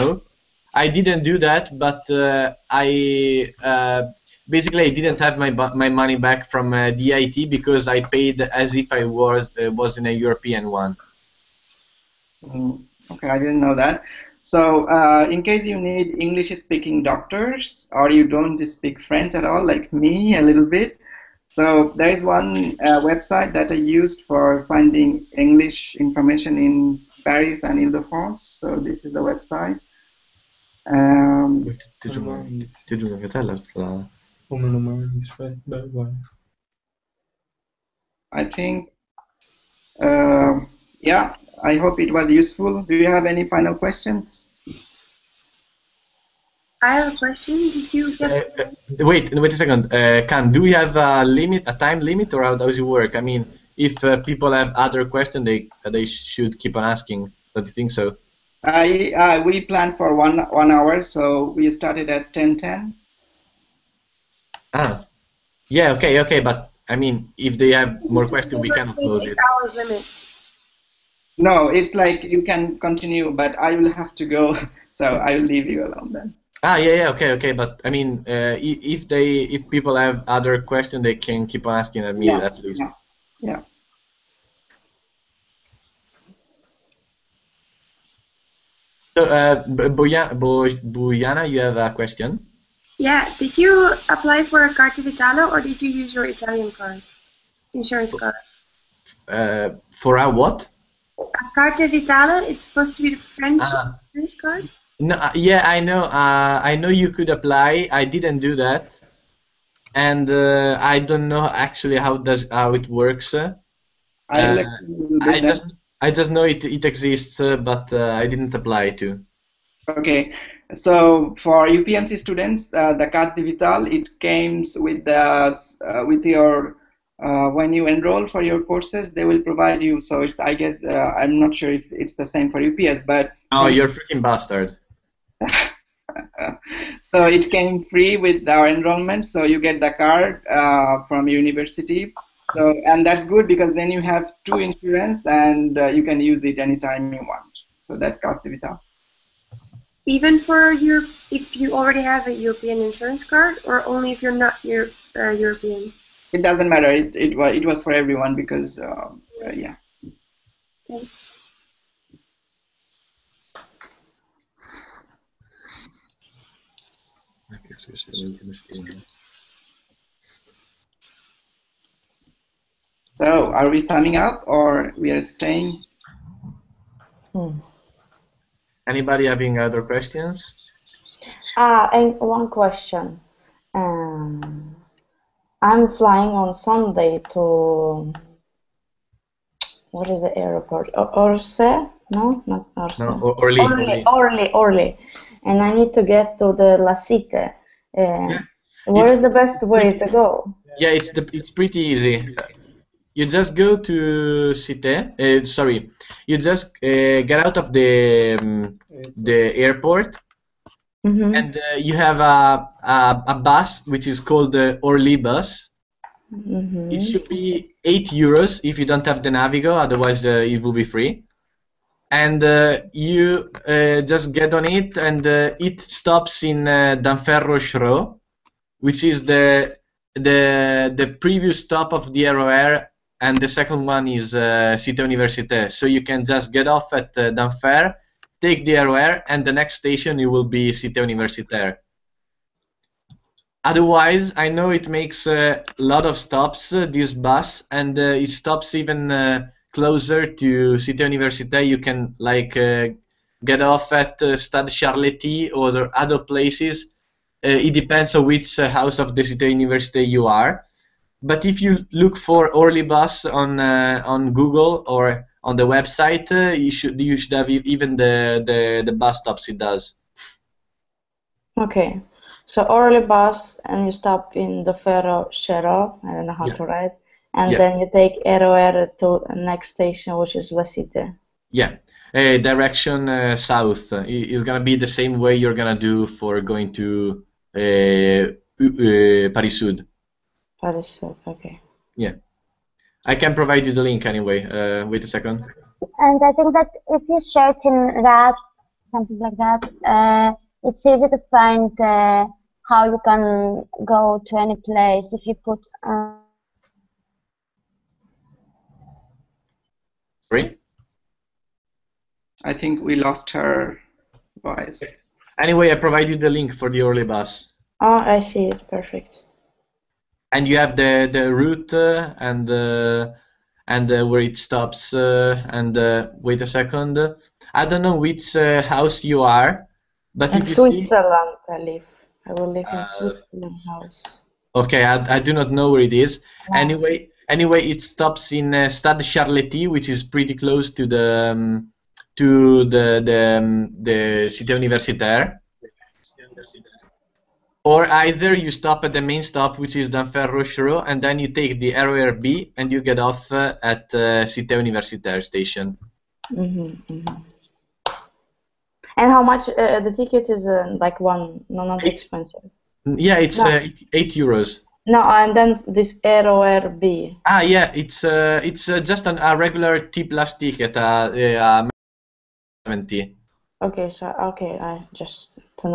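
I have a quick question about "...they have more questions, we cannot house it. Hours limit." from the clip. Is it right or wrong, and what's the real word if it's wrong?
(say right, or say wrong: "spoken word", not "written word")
wrong: "close", not "house".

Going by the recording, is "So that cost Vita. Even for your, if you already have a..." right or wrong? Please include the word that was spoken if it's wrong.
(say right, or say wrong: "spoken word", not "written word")
right.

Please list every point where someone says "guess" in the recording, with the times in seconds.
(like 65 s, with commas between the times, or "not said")
130 s.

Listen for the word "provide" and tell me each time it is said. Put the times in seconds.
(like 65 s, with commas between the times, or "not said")
129 s, 293 s, 315 s.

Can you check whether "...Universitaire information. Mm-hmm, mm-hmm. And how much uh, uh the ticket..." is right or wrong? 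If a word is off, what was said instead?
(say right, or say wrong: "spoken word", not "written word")
wrong: "station", not "information".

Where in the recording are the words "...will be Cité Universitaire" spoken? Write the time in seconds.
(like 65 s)
240 s.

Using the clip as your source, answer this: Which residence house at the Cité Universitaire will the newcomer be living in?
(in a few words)
Switzerland house.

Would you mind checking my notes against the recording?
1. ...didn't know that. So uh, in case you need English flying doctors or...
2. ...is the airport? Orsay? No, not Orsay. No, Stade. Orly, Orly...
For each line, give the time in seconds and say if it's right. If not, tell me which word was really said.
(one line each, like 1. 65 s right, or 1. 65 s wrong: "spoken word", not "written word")
1. 13 s wrong: "speaking", not "flying"
2. 190 s wrong: "Orly", not "Stade".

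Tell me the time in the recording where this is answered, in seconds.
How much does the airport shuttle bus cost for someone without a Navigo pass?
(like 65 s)
217 s.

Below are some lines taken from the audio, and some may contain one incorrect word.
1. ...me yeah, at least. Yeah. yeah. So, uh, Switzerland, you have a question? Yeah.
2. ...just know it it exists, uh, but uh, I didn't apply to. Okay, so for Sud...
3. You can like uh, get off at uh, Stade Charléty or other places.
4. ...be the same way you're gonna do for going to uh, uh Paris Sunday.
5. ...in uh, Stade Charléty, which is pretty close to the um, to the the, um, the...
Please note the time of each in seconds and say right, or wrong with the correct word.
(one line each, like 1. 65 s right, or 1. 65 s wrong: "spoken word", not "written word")
1. 82 s wrong: "Bojana", not "Switzerland"
2. 116 s wrong: "UPMC", not "Sud"
3. 251 s right
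4. 284 s wrong: "Sud", not "Sunday"
5. 338 s right.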